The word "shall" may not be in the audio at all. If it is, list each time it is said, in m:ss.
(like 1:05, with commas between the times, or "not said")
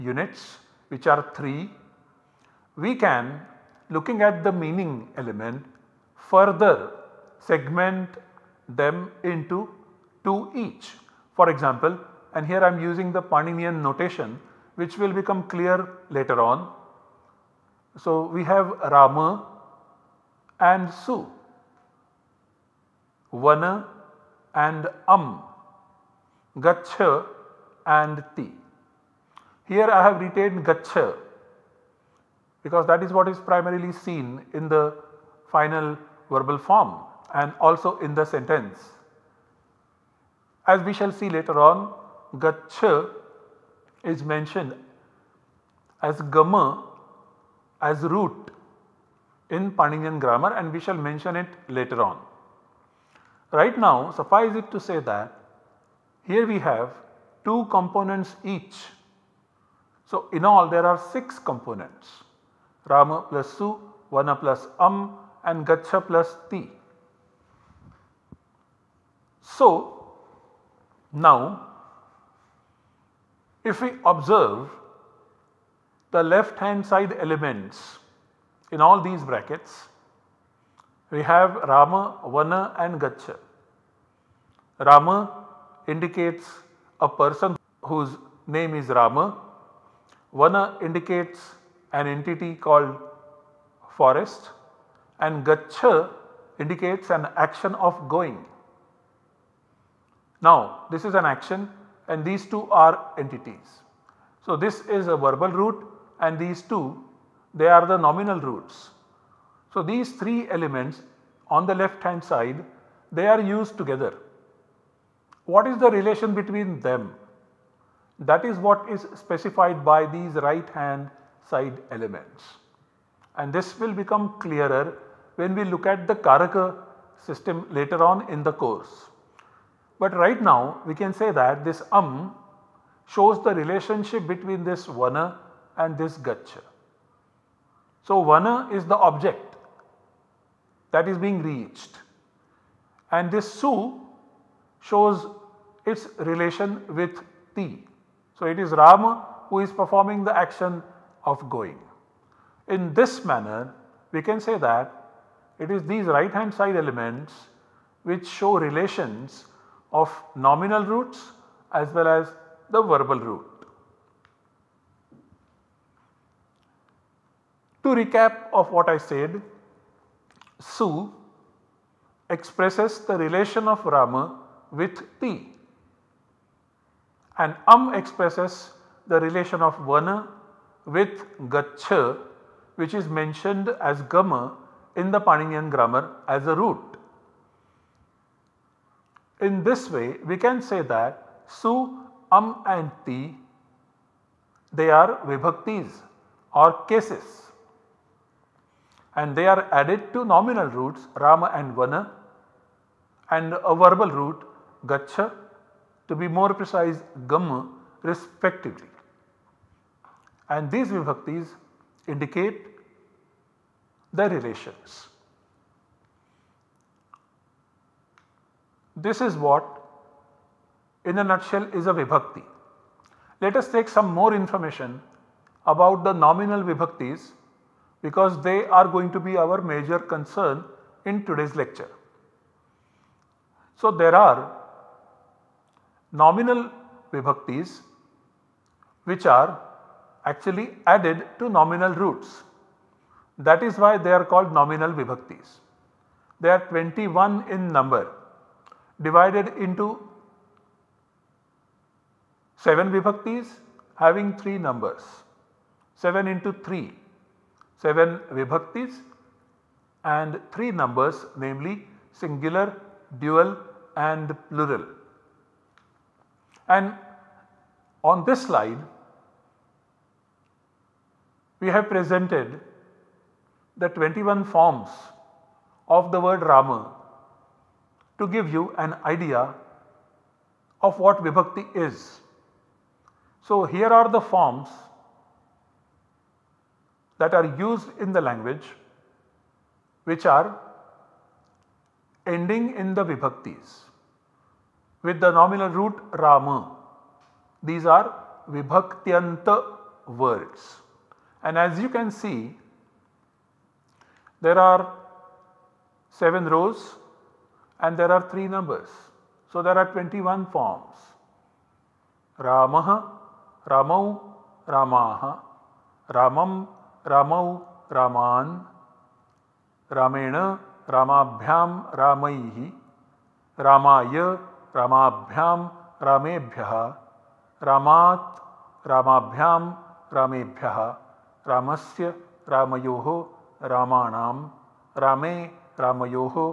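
0:40, 0:50.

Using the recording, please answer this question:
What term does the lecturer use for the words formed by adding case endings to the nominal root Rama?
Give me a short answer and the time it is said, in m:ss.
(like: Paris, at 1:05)
vibhaktyanta words, at 4:58.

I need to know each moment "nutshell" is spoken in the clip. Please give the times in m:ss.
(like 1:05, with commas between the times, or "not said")
3:41.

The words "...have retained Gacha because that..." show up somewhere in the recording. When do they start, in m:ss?
0:30.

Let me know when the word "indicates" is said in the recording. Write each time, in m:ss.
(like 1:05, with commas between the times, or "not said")
1:25, 1:30, 1:36, 3:32.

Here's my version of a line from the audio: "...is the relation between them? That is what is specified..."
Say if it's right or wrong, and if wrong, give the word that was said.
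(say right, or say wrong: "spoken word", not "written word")
right.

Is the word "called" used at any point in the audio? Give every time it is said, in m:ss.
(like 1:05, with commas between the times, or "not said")
1:32, 4:04.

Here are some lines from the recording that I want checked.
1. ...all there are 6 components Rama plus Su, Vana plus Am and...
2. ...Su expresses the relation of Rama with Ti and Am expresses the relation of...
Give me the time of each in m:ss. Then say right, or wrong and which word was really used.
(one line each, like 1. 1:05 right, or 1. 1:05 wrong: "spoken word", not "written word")
1. 1:00 right
2. 2:50 right.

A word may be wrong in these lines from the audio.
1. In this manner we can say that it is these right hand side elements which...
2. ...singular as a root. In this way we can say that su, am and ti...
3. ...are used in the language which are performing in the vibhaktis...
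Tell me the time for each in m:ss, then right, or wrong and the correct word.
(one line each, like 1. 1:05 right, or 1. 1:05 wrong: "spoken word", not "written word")
1. 2:32 right
2. 3:05 wrong: "grammar", not "singular"
3. 4:47 wrong: "ending", not "performing".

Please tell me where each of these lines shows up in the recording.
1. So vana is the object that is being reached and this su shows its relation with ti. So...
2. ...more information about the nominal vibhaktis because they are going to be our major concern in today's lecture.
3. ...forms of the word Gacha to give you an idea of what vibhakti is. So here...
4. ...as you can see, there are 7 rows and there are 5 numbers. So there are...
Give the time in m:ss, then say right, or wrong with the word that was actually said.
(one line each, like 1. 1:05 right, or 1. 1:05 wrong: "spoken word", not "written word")
1. 2:18 right
2. 3:44 right
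3. 4:34 wrong: "Rama", not "Gacha"
4. 5:01 wrong: "3", not "5".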